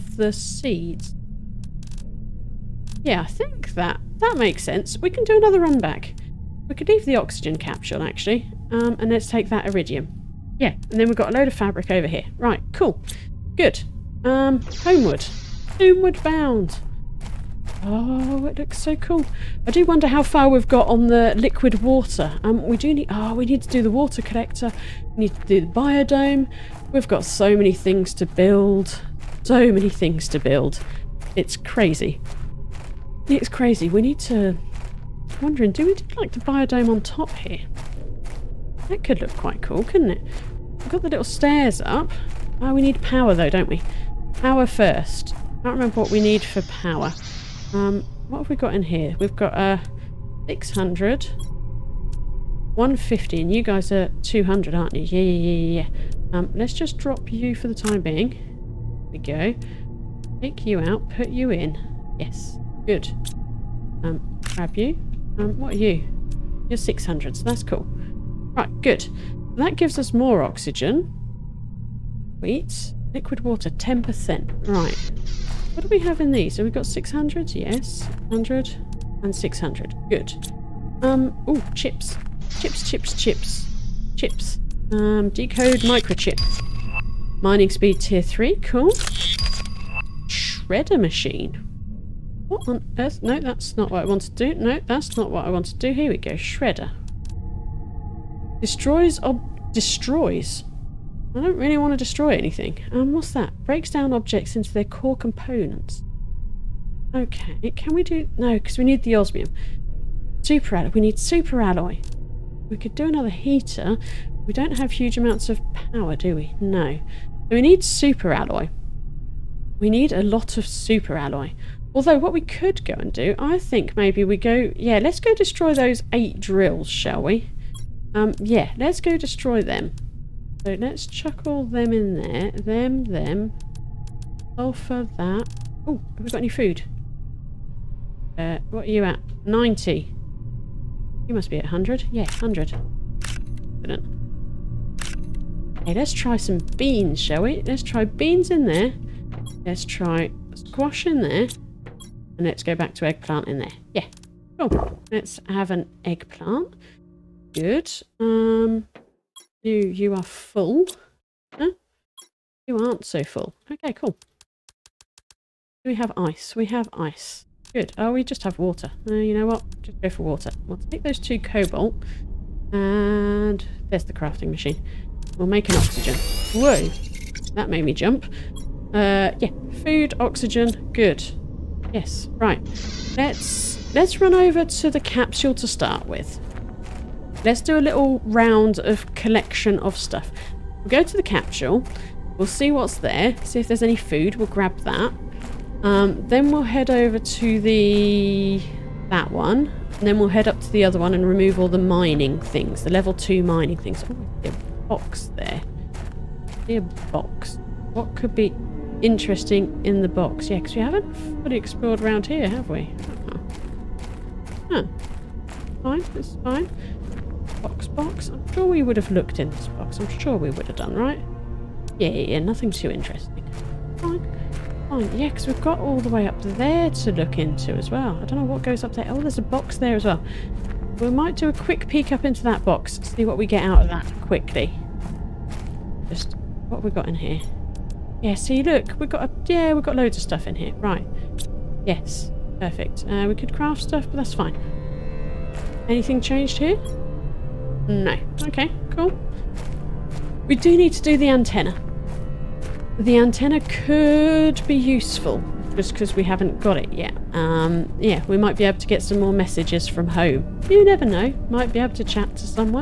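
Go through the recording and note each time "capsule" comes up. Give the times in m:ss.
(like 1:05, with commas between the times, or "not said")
0:07, 3:04, 3:11.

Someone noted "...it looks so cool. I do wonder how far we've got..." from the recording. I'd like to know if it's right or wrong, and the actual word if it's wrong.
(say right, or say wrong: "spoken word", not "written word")
right.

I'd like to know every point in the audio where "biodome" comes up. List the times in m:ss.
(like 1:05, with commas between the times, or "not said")
0:25, 0:36.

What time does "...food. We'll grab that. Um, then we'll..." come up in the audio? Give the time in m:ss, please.
3:13.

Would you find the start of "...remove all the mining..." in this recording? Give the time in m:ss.
3:21.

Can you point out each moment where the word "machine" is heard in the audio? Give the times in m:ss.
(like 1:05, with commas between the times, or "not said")
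1:30, 2:54.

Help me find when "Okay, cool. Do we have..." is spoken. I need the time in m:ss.
2:43.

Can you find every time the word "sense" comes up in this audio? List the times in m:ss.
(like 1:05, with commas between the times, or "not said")
0:04.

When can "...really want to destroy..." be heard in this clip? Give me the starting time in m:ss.
1:41.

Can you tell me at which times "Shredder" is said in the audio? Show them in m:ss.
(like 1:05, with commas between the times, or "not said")
1:30, 1:36.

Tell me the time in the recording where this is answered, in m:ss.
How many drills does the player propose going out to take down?
2:06.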